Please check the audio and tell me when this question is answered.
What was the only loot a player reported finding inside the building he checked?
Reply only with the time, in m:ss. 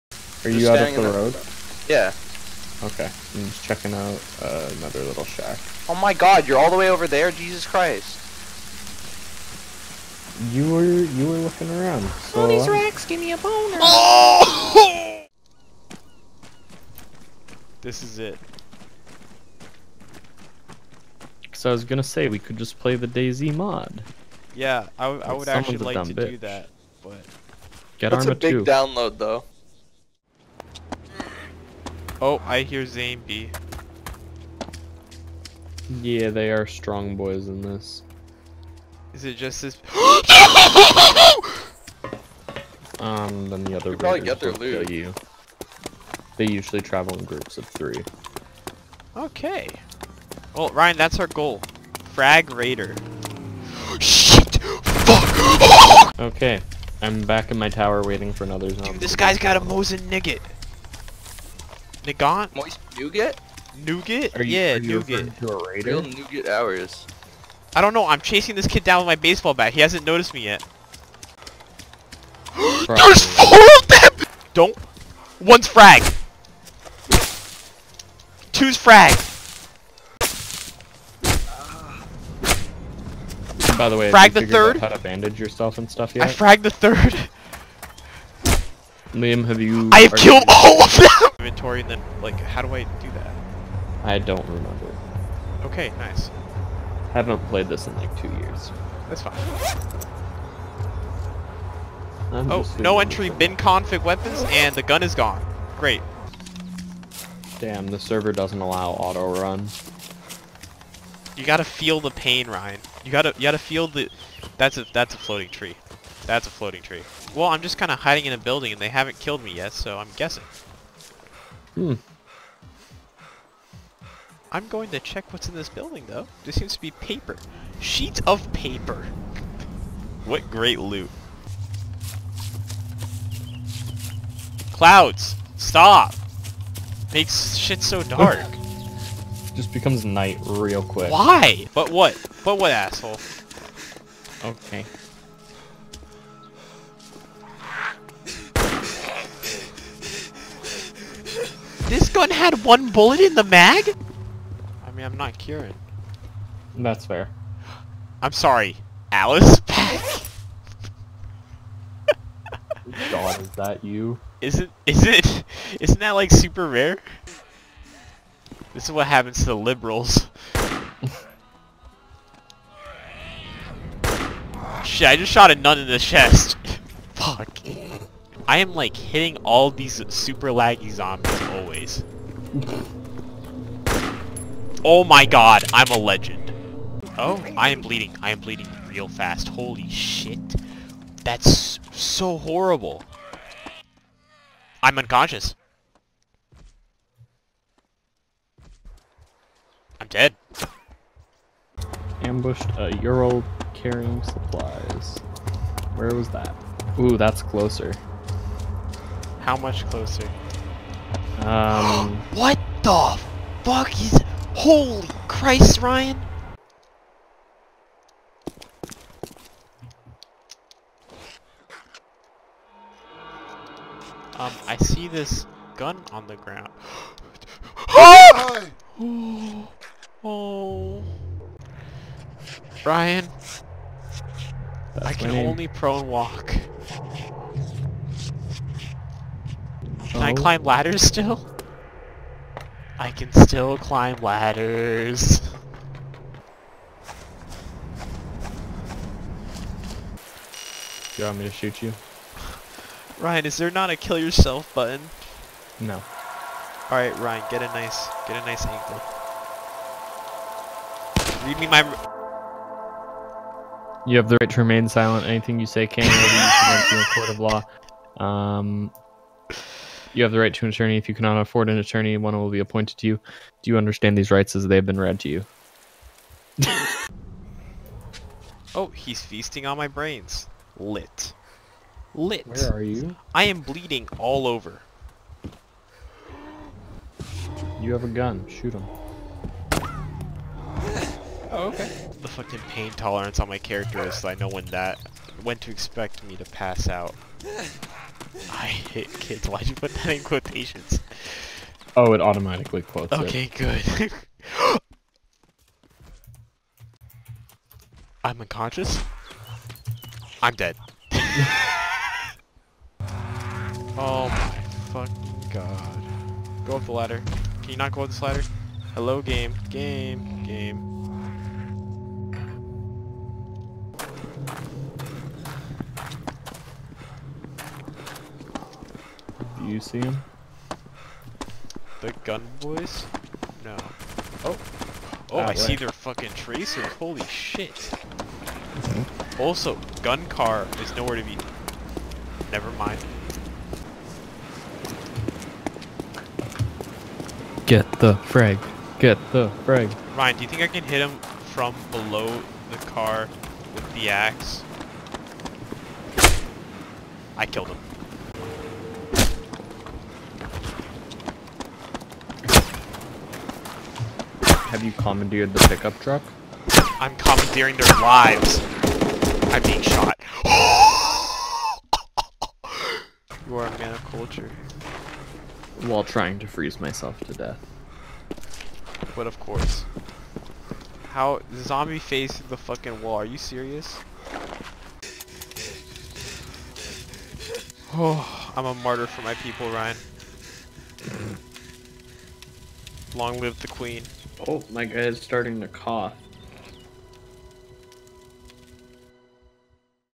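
2:07.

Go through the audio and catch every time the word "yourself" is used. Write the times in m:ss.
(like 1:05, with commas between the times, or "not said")
1:25, 4:14.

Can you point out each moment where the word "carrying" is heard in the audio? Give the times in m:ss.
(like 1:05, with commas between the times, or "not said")
3:23.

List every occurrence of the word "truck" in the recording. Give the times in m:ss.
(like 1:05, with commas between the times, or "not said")
6:05.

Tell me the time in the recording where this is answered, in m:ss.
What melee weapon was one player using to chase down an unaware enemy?
1:09.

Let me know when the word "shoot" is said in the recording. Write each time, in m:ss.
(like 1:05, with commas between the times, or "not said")
4:11, 4:48.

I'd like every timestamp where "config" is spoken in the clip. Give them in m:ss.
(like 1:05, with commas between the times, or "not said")
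1:43.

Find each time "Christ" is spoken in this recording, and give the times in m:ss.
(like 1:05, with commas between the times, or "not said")
0:07, 3:35.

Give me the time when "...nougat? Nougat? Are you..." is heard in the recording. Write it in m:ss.
1:02.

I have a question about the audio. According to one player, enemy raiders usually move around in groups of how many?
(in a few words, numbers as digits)
3.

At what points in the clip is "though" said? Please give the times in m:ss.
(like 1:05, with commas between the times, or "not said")
0:29, 2:06.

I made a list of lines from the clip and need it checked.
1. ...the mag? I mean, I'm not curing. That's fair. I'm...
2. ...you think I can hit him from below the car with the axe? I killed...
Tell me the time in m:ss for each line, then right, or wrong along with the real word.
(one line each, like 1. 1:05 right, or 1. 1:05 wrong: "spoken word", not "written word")
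1. 2:33 right
2. 5:50 right.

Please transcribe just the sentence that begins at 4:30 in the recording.
If you cannot afford an attorney, one will be appointed to you.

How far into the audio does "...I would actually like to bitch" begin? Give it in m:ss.
0:25.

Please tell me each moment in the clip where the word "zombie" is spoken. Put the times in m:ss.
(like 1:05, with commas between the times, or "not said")
0:58, 3:00, 6:21.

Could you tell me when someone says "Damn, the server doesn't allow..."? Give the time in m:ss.
1:47.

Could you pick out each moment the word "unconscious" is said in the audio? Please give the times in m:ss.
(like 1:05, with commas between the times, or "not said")
3:14, 5:08.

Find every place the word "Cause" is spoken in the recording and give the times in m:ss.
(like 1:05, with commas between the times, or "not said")
0:21.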